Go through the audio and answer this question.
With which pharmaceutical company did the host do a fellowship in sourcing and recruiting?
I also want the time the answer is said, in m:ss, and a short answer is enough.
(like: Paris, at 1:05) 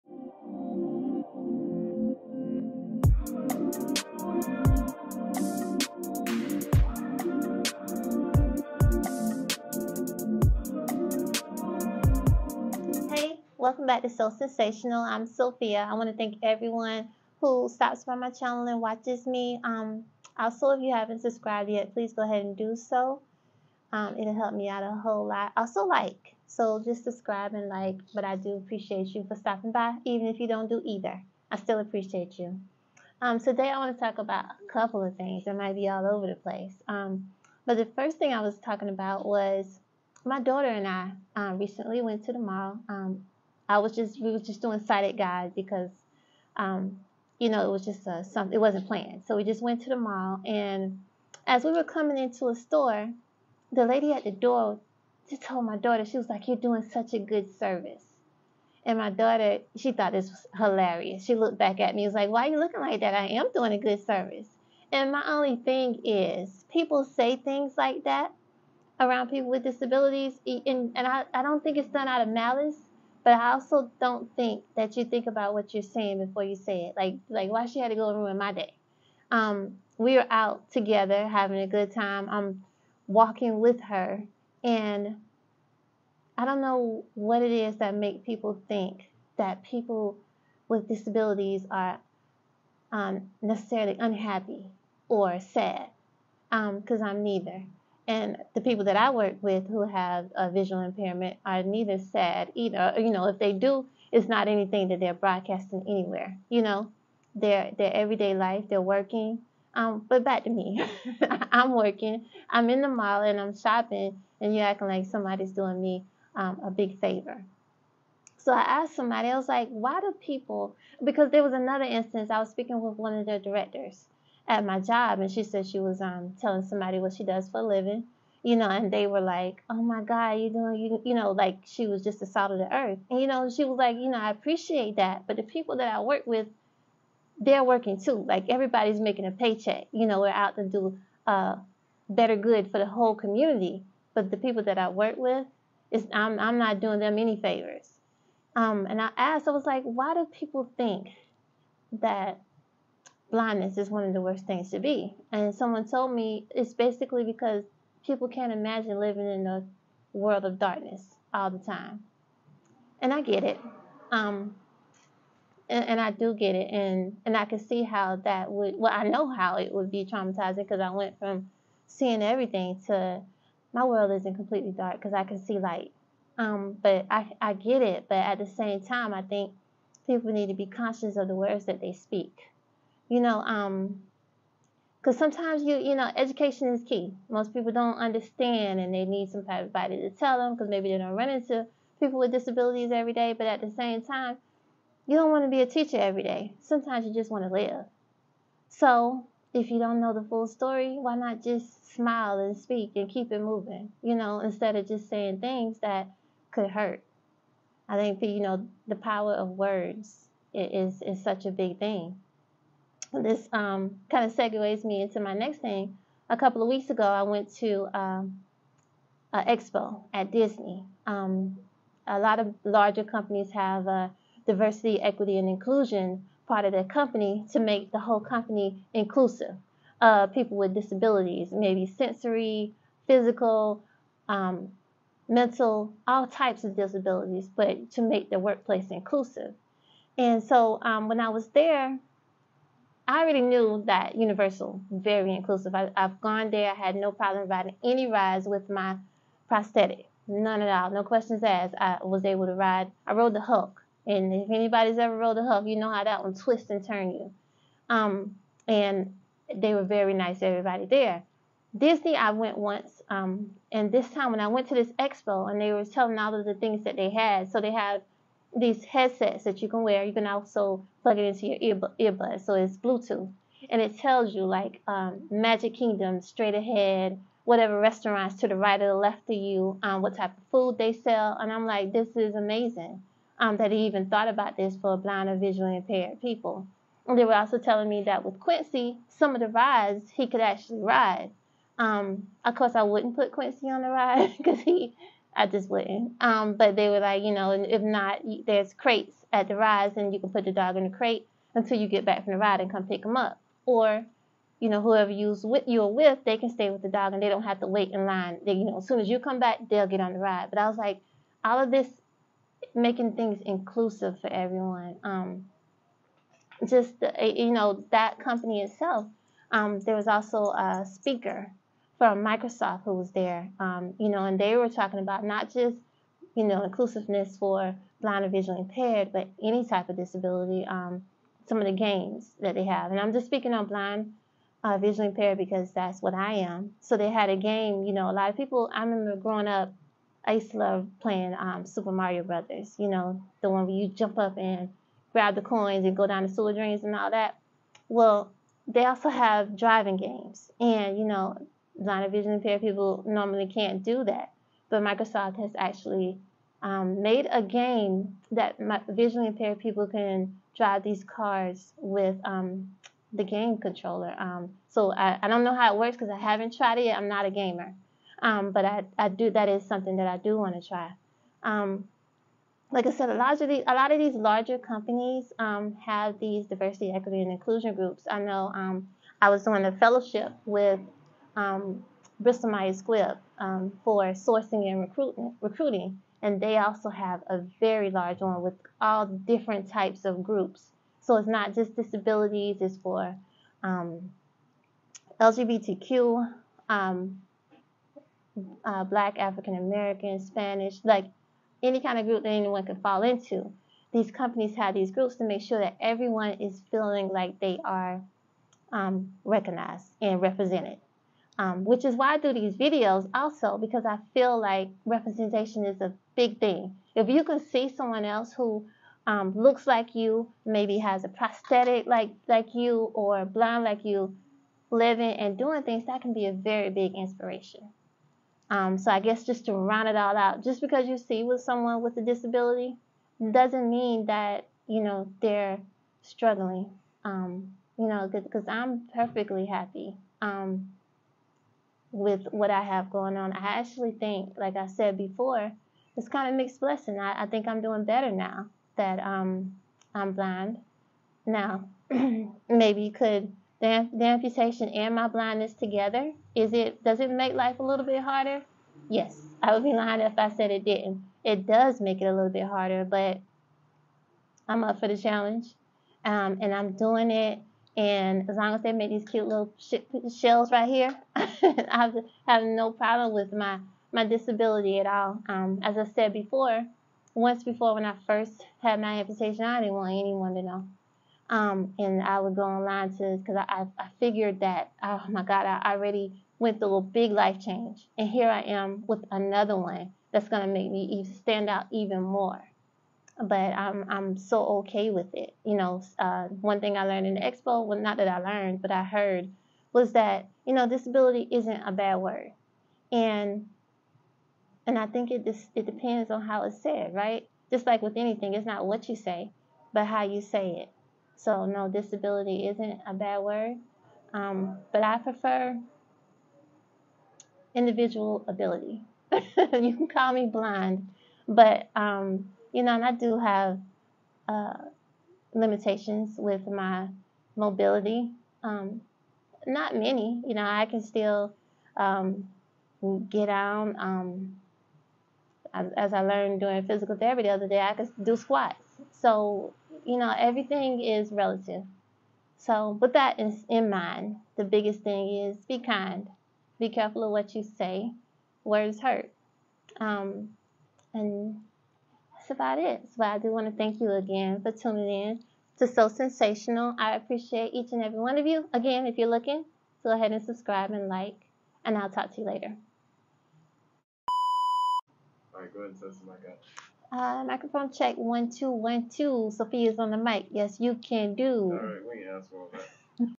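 Bristol Myers Squibb, at 6:22.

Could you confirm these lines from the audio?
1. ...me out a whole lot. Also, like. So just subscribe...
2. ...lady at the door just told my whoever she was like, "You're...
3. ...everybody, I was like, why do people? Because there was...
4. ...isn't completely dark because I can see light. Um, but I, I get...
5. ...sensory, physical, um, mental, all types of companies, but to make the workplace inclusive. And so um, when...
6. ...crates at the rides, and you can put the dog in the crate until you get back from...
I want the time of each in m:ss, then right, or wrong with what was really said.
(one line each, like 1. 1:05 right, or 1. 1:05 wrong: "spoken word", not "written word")
1. 0:24 right
2. 0:53 wrong: "daughter", not "whoever"
3. 1:58 wrong: "somebody", not "everybody"
4. 2:54 right
5. 3:51 wrong: "disabilities", not "companies"
6. 4:58 right.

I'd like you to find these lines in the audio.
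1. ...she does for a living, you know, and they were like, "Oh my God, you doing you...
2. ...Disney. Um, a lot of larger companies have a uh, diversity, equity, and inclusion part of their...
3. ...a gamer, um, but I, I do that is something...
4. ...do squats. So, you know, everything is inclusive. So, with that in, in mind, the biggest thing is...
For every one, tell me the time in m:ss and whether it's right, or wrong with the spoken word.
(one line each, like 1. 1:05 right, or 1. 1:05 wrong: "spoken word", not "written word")
1. 2:07 right
2. 3:40 right
3. 6:07 right
4. 8:58 wrong: "relative", not "inclusive".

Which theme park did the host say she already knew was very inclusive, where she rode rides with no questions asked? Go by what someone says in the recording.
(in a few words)
Universal.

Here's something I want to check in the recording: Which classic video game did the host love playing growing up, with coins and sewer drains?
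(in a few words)
Super Mario Brothers.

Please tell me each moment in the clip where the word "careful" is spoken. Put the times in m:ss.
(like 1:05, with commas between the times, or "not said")
9:06.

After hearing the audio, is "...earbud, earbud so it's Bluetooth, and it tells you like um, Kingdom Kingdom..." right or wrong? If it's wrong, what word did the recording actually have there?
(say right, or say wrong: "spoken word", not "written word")
wrong: "Magic", not "Kingdom".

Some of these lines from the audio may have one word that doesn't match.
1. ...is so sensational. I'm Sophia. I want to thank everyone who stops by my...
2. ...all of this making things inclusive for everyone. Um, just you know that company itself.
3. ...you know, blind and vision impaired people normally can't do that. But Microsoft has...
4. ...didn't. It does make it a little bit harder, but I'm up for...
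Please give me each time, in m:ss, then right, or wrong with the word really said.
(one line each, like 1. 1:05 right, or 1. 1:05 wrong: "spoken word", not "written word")
1. 0:14 right
2. 5:11 right
3. 5:50 right
4. 7:40 right.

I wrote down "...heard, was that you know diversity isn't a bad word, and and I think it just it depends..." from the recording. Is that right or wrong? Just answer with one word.
wrong.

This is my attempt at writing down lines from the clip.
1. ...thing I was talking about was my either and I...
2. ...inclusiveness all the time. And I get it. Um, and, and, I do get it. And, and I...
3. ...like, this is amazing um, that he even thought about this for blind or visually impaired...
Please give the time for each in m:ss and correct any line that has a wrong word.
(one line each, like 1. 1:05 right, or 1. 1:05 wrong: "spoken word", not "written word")
1. 0:38 wrong: "daughter", not "either"
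2. 2:40 wrong: "darkness", not "inclusiveness"
3. 4:41 right.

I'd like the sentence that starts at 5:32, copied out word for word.
And I'm just speaking on blind, uh, visually impaired because that's what I am.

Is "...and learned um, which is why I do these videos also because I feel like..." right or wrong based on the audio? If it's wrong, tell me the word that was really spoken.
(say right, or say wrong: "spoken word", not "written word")
wrong: "represented", not "learned".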